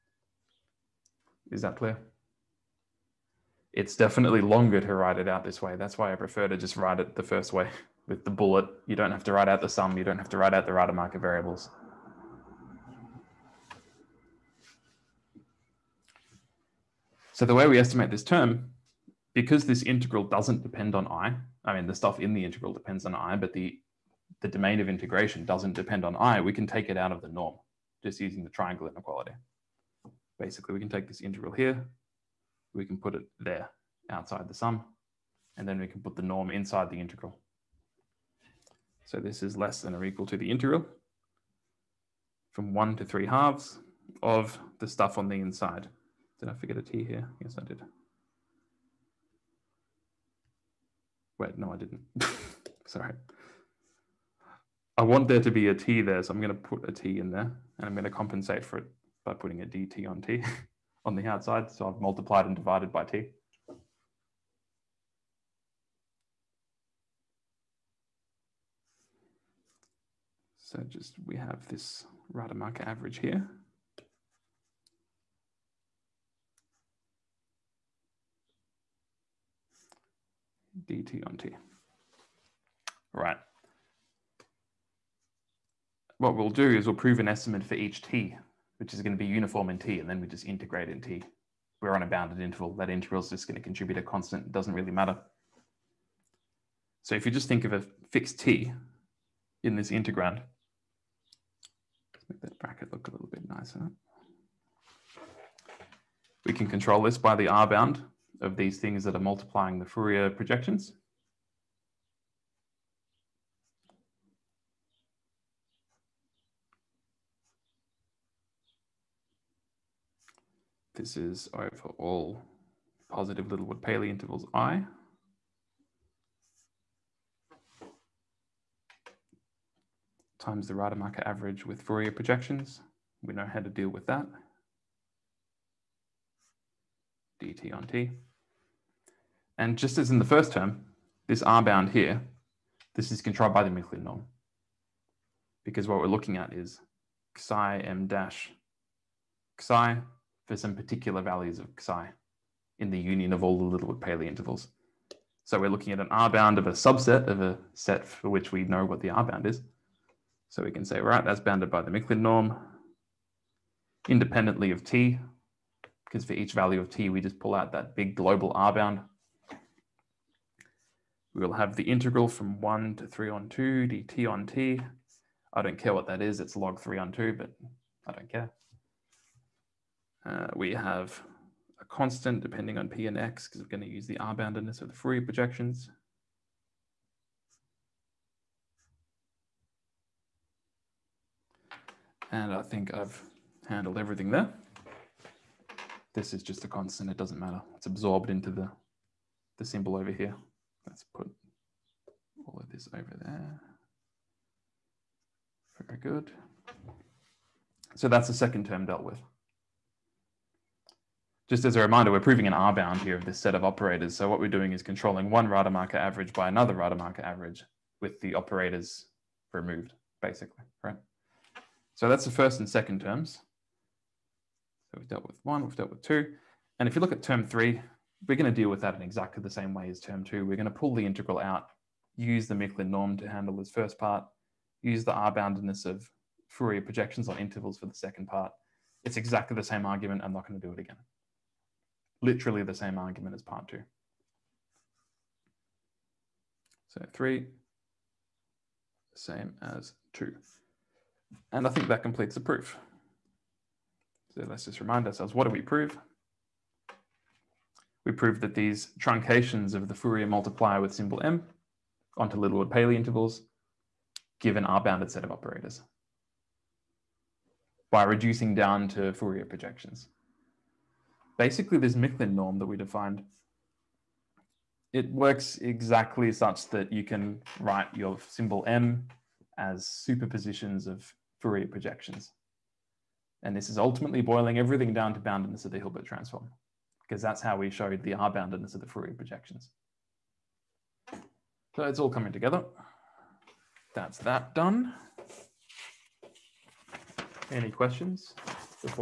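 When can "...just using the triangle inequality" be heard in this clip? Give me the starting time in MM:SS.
00:28.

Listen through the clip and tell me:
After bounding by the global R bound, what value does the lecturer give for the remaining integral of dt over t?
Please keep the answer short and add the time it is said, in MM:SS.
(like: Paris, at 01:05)
log 3/2, at 02:56.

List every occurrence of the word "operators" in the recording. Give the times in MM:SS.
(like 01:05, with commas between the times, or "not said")
03:33, 03:38, 04:25.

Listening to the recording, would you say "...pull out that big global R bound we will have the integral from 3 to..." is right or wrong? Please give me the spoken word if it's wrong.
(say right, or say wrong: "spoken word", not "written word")
wrong: "1", not "3".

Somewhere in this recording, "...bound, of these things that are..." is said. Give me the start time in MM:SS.
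01:47.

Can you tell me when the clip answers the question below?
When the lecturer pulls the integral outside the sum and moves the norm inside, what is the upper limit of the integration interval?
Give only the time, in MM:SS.
00:43.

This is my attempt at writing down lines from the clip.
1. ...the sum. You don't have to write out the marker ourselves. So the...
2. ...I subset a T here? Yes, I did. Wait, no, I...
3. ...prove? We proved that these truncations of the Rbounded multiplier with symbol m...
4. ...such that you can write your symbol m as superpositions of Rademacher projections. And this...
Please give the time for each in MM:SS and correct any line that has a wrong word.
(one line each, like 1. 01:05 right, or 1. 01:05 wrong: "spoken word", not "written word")
1. 00:09 wrong: "variables", not "ourselves"
2. 00:46 wrong: "forget", not "subset"
3. 04:15 wrong: "Fourier", not "Rbounded"
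4. 04:36 wrong: "Fourier", not "Rademacher".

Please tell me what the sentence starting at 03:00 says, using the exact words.
Uh, we have a constant depending on p and x because we're going to use the r-boundedness of the Fourier projections.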